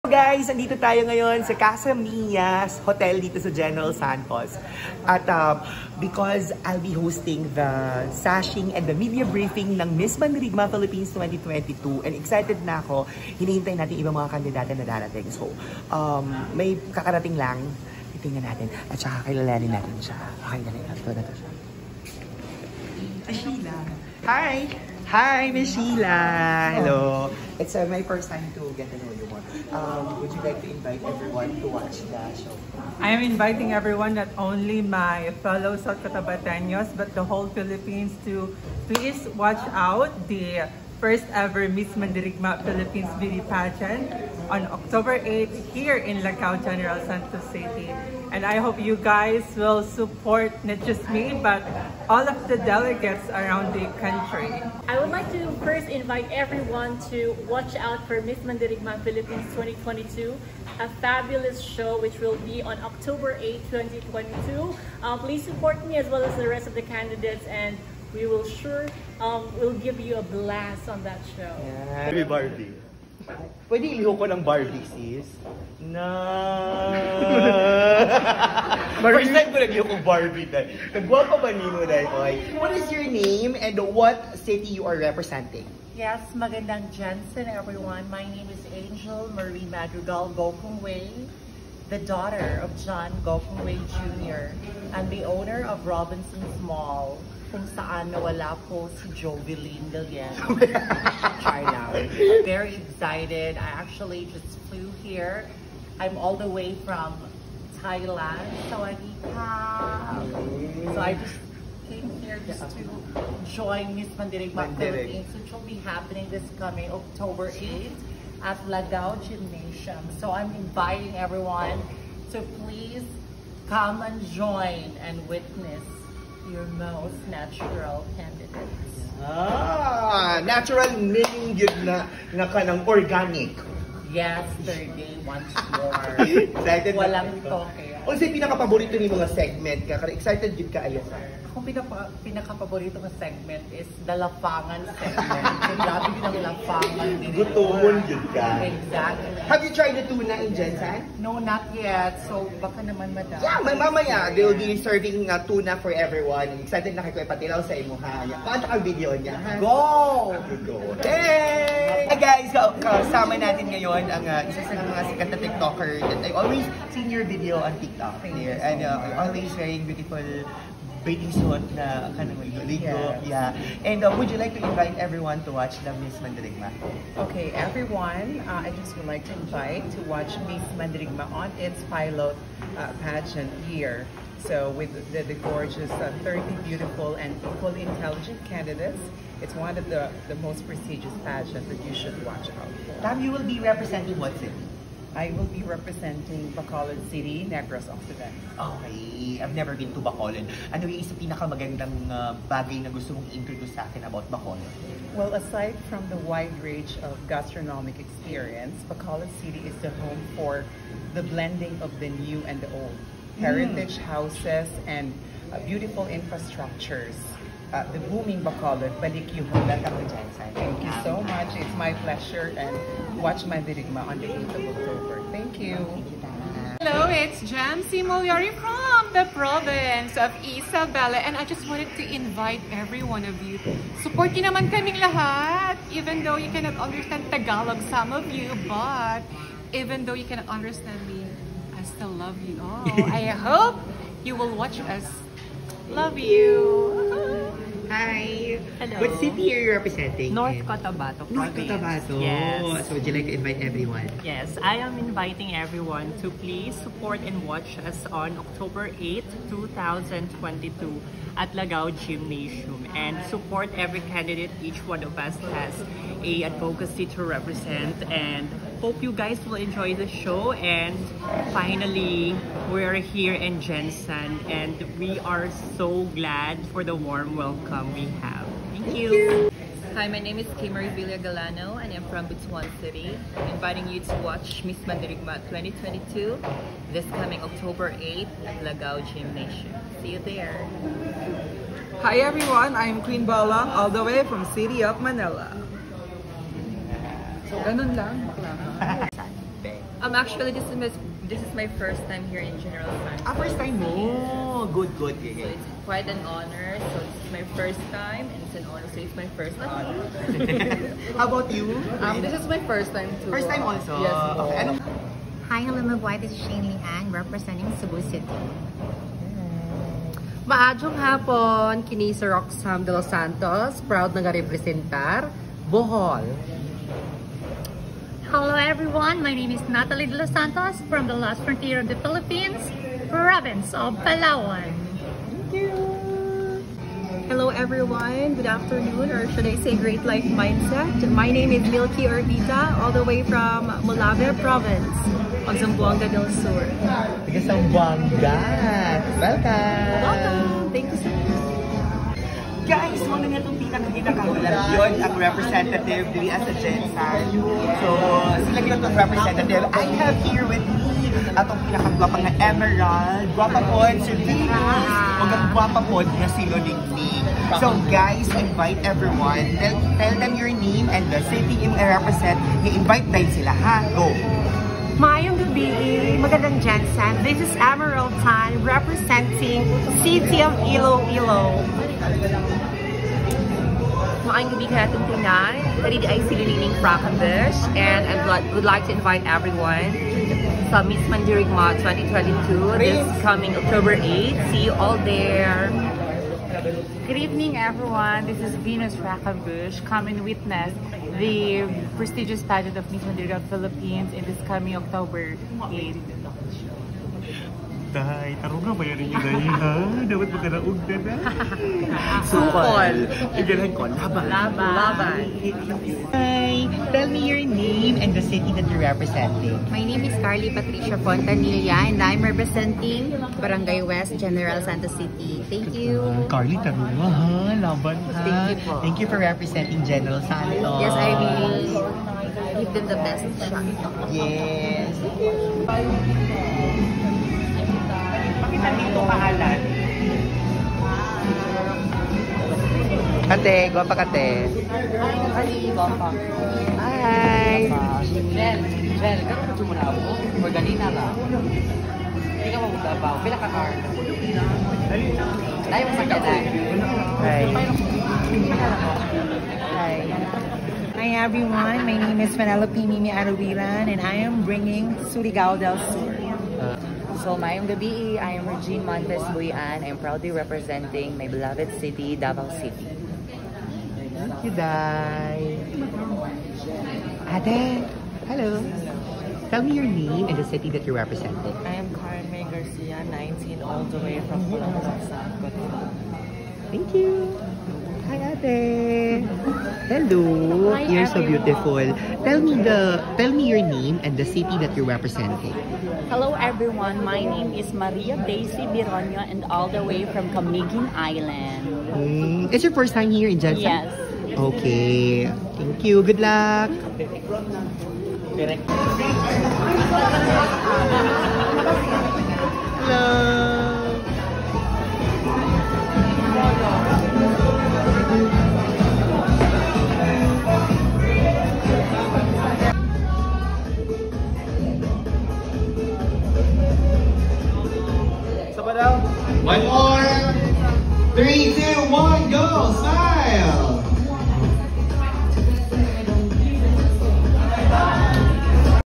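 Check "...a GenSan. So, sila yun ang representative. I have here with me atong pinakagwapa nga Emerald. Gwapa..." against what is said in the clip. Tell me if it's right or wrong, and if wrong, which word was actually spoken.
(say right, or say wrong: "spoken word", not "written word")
right.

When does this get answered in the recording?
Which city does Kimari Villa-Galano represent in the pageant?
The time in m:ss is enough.
4:42.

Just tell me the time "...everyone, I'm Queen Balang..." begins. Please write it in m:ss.
4:52.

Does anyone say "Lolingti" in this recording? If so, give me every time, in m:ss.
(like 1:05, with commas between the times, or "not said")
6:06.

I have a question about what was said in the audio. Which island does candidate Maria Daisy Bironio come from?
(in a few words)
Camiguin Island.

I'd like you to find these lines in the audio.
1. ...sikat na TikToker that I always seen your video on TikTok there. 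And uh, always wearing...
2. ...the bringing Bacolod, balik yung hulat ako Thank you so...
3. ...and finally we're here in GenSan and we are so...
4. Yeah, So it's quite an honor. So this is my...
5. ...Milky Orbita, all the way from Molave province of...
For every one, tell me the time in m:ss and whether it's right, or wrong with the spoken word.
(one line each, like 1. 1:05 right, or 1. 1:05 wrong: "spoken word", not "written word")
1. 2:45 right
2. 3:37 wrong: "booming", not "bringing"
3. 4:30 right
4. 5:05 right
5. 5:41 right.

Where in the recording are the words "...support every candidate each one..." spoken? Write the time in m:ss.
4:23.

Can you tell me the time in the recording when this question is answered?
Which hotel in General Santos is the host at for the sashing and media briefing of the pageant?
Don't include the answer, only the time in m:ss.
0:01.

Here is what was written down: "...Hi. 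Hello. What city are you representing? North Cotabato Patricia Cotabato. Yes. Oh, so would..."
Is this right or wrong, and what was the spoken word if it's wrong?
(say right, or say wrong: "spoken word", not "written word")
wrong: "North", not "Patricia".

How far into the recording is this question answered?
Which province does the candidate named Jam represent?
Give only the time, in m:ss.
3:50.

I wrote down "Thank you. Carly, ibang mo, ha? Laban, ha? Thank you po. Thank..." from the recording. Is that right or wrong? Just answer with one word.
wrong.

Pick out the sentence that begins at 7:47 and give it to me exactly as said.
So, mayong gabi, I am Regine Montes Buyan.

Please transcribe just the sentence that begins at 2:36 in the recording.
Excited na kay Kuya Patilaw sa imo ha.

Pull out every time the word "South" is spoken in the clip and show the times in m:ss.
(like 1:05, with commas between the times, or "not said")
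0:35, 8:05.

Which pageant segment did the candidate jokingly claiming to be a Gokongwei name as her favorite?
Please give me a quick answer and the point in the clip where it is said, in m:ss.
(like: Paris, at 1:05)
lapangan segment, at 2:24.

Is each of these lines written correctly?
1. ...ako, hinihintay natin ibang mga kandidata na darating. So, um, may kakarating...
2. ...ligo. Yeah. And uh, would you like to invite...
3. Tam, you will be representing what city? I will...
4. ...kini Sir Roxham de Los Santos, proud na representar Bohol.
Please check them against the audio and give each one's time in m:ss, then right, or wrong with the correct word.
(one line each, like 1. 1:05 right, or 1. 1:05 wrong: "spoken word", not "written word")
1. 0:12 right
2. 2:52 right
3. 3:13 right
4. 5:21 right.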